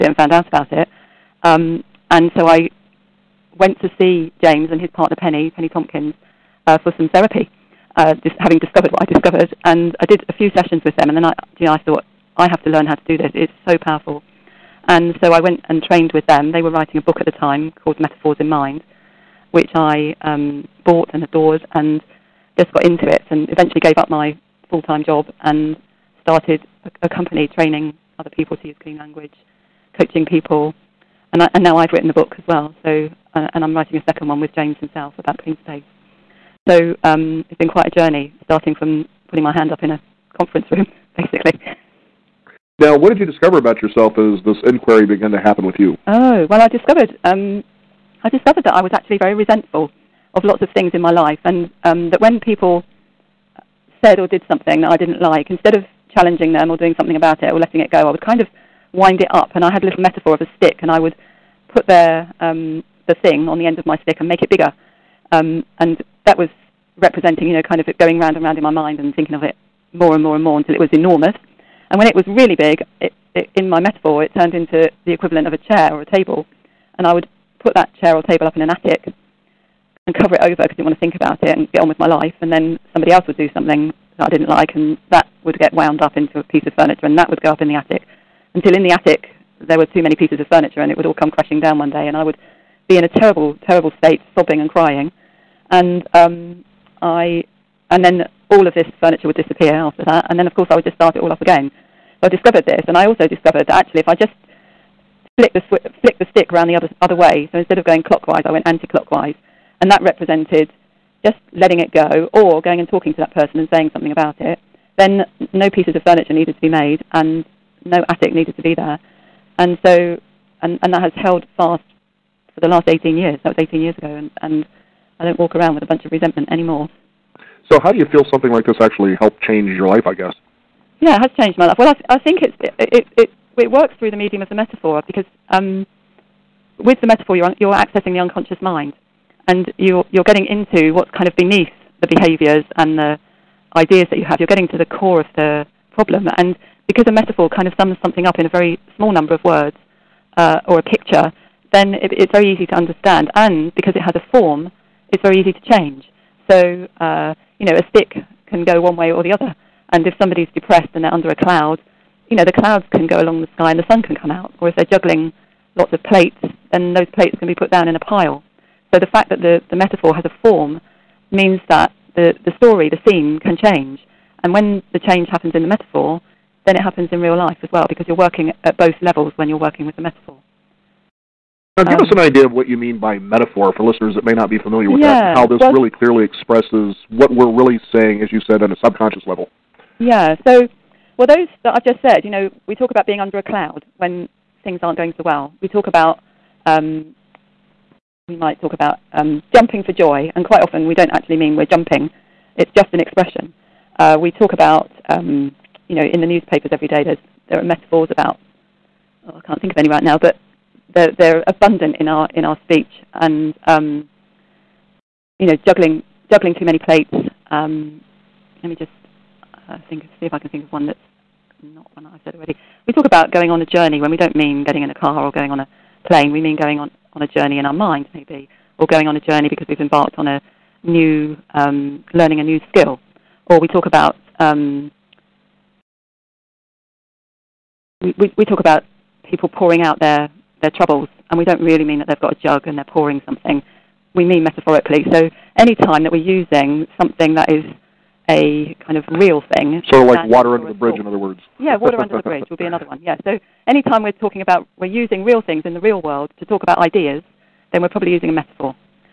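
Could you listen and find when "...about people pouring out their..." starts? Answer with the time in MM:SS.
03:58.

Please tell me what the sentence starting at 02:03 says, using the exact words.
That was 18 years ago, and, and I don't walk around with a bunch of resentment anymore.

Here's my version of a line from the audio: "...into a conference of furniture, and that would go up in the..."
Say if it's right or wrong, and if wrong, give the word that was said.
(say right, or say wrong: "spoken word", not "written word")
wrong: "piece", not "conference".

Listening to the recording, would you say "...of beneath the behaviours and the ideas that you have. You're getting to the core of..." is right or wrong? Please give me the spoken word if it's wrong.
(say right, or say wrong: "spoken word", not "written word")
right.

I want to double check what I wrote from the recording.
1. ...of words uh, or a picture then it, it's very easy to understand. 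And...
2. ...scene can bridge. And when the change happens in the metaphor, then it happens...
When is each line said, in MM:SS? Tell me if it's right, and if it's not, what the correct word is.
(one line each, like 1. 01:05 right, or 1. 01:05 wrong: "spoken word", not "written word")
1. 02:29 right
2. 02:53 wrong: "change", not "bridge".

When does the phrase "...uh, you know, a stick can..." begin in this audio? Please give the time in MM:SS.
02:36.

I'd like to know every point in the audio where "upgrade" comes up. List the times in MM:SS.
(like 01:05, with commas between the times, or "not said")
not said.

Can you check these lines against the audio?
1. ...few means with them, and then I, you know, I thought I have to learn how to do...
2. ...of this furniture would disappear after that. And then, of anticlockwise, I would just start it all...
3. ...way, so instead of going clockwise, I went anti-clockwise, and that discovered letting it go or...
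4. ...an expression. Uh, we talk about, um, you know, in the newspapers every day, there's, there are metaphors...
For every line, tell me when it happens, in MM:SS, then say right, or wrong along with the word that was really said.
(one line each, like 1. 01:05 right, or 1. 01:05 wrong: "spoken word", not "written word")
1. 00:10 wrong: "sessions", not "means"
2. 01:38 wrong: "course", not "anticlockwise"
3. 01:47 wrong: "represented", not "discovered"
4. 03:22 right.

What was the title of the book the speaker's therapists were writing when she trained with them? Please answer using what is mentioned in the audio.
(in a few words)
Metaphors in Mind.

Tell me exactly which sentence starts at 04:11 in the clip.
Yeah, water under the bridge will be another one.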